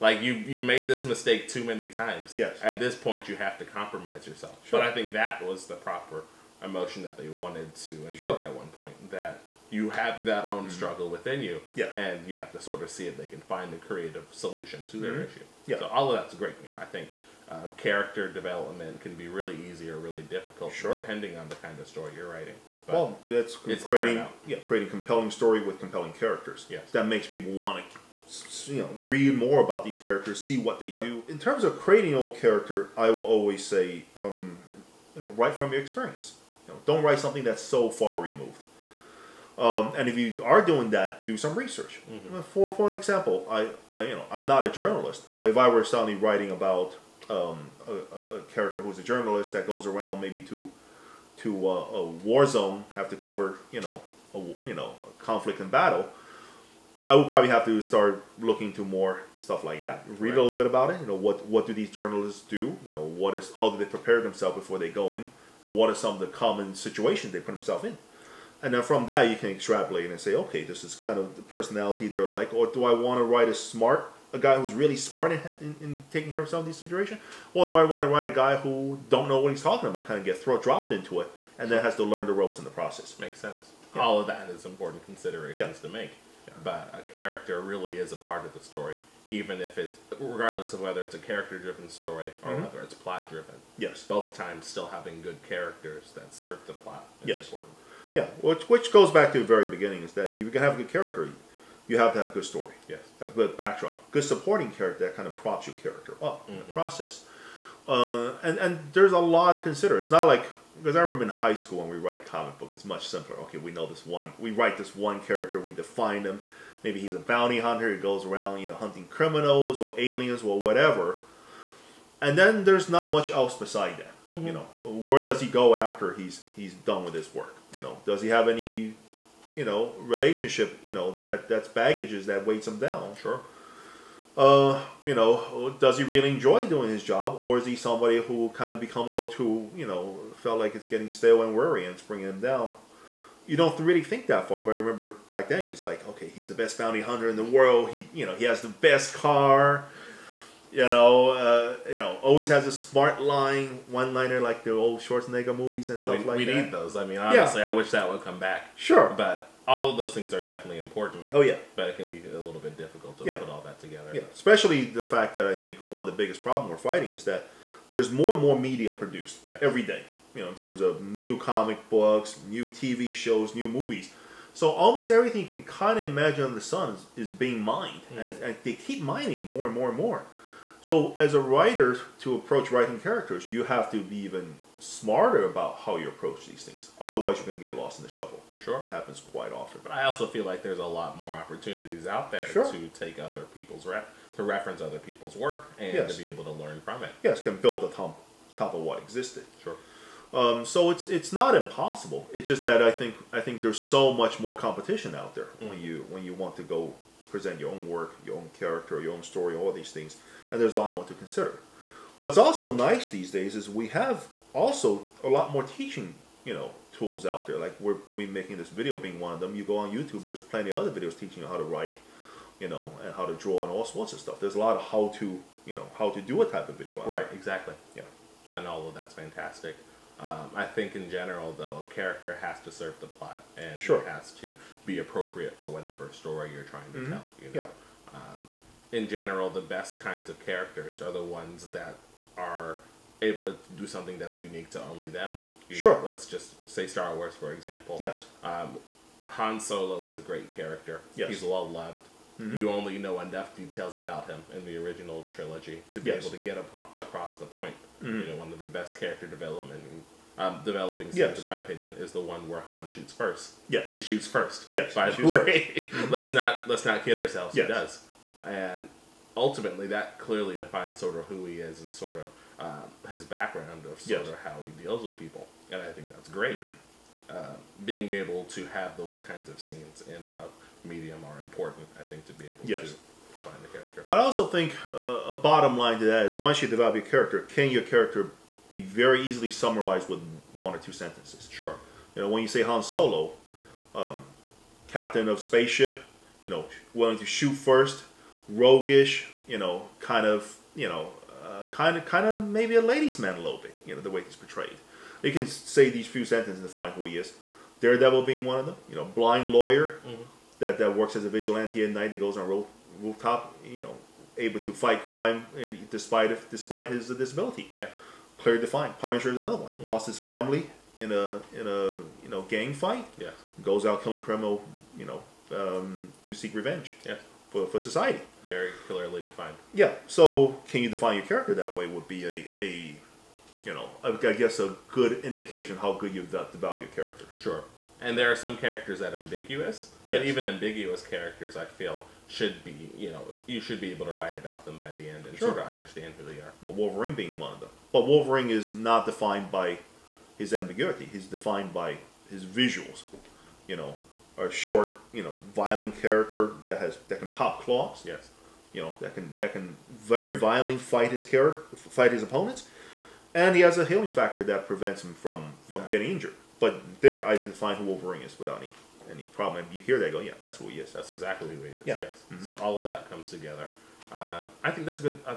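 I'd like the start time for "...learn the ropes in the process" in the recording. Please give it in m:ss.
1:22.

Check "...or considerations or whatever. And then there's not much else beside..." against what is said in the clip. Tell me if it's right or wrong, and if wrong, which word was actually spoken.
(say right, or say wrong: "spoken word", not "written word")
wrong: "aliens", not "considerations".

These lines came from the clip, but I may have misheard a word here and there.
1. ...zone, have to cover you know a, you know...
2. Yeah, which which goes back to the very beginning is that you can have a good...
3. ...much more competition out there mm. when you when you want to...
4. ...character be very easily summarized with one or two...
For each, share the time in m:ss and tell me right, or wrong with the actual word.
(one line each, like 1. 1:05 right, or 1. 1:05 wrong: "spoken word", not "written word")
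1. 0:52 right
2. 1:38 right
3. 3:24 right
4. 4:47 right.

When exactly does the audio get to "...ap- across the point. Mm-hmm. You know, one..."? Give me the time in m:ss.
4:16.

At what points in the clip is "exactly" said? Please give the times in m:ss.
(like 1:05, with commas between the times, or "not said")
3:47, 6:11.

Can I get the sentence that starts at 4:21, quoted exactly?
in my opinion, is the one where Han shoots first.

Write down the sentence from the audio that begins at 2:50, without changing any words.
You know, in terms of new comic books, new TV shows, new movies.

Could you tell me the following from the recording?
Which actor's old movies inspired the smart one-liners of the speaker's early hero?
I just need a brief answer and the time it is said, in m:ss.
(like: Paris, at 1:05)
Schwarzenegger, at 2:35.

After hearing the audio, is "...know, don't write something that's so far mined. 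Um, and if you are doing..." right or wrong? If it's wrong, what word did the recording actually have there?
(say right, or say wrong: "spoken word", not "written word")
wrong: "removed", not "mined".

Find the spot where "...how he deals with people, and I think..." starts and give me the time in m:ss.
4:34.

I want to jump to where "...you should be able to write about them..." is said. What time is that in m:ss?
5:43.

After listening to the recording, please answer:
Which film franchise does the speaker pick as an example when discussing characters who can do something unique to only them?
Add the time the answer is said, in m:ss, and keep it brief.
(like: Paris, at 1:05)
Star Wars, at 4:06.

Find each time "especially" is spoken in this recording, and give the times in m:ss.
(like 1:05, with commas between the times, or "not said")
2:44.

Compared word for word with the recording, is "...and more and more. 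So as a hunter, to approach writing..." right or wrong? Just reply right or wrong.
wrong.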